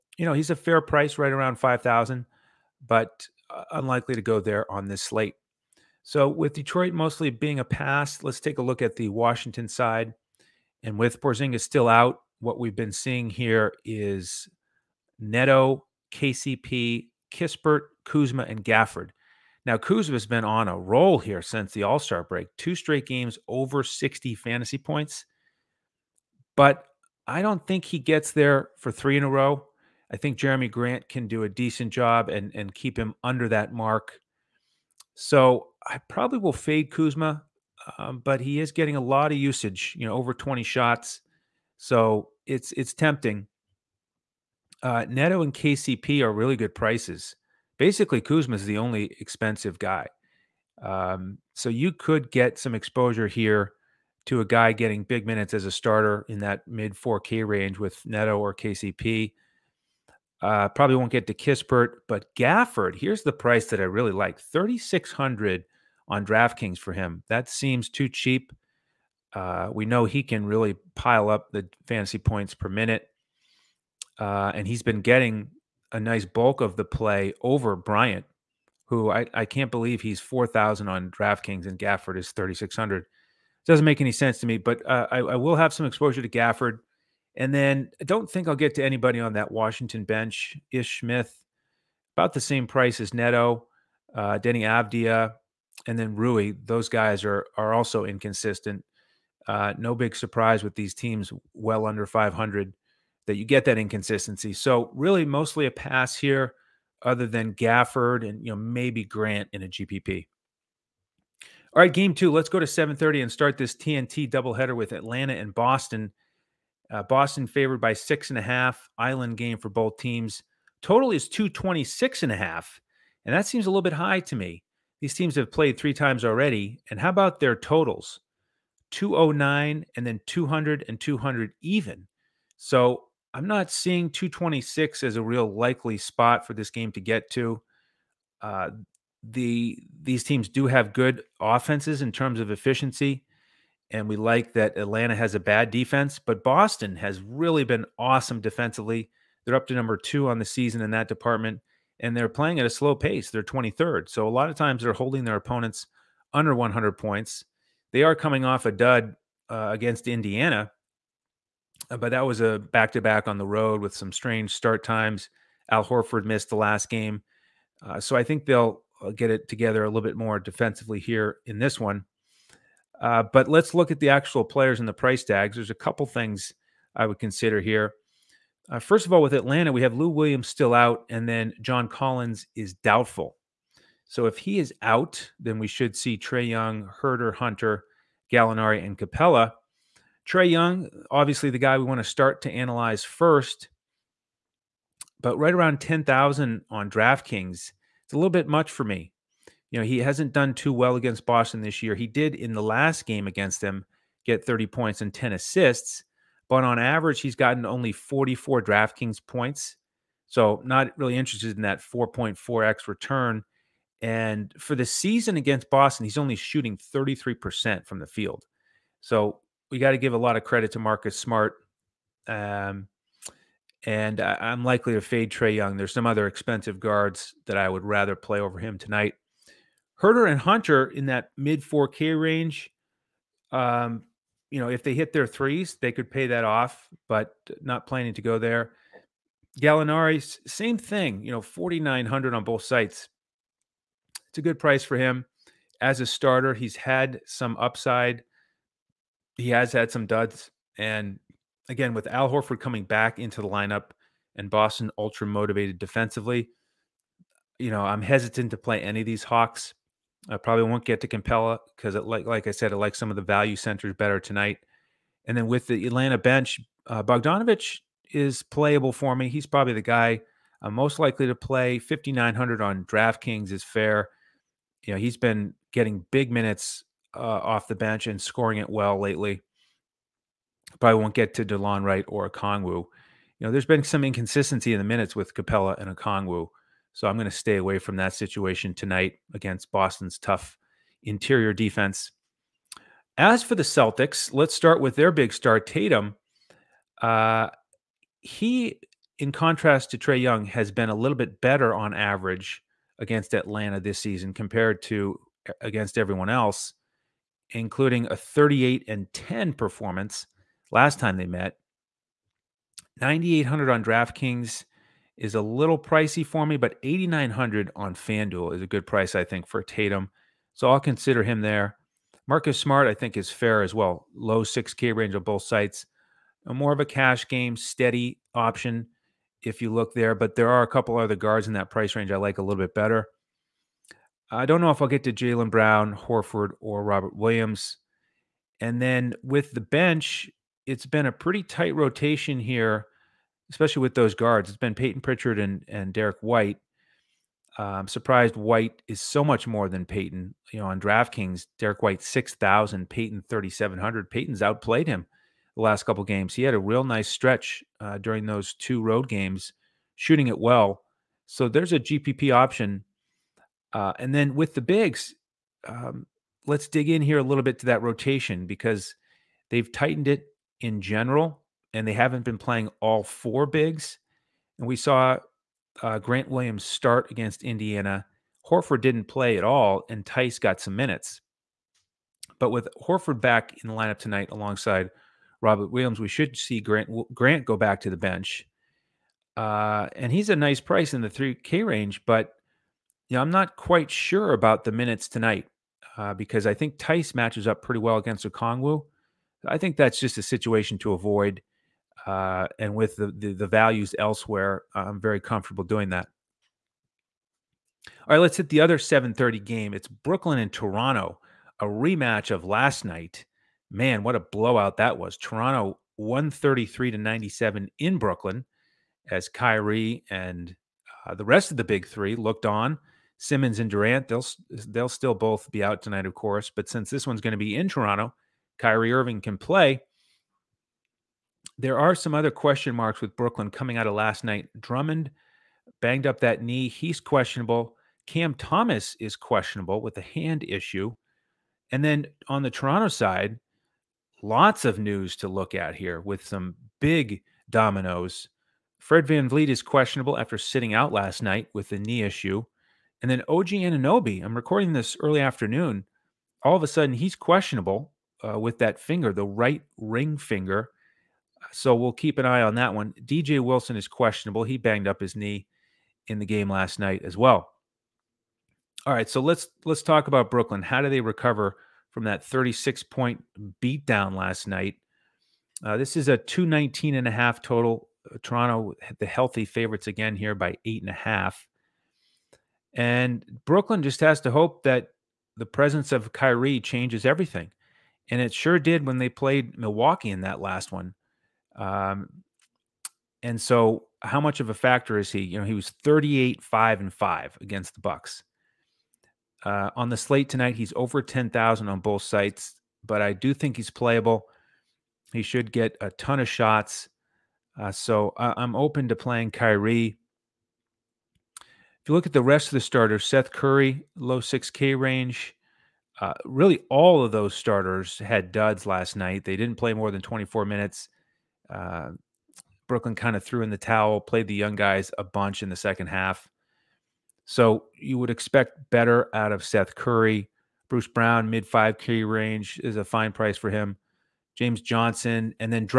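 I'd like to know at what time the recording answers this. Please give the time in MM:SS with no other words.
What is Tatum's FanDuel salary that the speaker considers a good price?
05:16.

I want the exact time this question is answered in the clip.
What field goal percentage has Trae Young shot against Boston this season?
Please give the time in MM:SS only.
03:36.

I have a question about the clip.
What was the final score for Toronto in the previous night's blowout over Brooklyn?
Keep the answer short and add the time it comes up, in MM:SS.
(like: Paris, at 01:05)
133, at 06:55.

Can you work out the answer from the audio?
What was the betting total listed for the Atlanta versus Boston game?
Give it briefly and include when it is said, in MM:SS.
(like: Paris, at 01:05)
226 and a half, at 02:01.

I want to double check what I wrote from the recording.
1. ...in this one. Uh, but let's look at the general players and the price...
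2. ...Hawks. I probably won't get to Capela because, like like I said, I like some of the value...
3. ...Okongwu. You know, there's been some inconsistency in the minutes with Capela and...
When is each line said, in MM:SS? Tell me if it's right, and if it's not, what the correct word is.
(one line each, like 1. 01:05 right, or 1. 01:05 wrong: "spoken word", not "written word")
1. 02:51 wrong: "actual", not "general"
2. 04:19 right
3. 04:42 right.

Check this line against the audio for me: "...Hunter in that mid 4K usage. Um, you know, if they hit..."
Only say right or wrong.
wrong.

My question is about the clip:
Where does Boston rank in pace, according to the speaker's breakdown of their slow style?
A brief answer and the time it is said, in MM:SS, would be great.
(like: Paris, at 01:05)
23rd, at 02:33.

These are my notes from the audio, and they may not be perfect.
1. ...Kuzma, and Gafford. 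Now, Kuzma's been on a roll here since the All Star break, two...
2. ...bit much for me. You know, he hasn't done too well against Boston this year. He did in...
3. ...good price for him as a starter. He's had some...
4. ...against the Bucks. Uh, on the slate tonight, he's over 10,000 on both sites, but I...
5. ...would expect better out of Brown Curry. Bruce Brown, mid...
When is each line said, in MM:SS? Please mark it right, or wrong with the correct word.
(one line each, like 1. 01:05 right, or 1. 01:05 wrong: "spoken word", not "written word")
1. 00:18 right
2. 03:18 right
3. 04:04 right
4. 08:17 right
5. 08:47 wrong: "Seth", not "Brown".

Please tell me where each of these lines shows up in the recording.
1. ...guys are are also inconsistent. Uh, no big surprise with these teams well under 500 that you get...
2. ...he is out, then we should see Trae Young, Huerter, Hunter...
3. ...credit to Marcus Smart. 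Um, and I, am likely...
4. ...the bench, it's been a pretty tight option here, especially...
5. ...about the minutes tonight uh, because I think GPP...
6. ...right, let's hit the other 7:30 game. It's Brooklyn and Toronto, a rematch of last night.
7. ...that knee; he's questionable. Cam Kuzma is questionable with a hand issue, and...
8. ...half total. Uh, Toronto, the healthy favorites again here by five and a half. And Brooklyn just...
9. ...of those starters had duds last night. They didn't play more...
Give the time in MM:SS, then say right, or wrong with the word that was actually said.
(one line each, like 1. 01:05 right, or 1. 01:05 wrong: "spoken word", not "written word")
1. 01:36 right
2. 03:04 right
3. 03:40 right
4. 05:39 wrong: "rotation", not "option"
5. 06:34 wrong: "Theis", not "GPP"
6. 06:48 right
7. 07:16 wrong: "Thomas", not "Kuzma"
8. 07:57 wrong: "eight", not "five"
9. 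08:37 right.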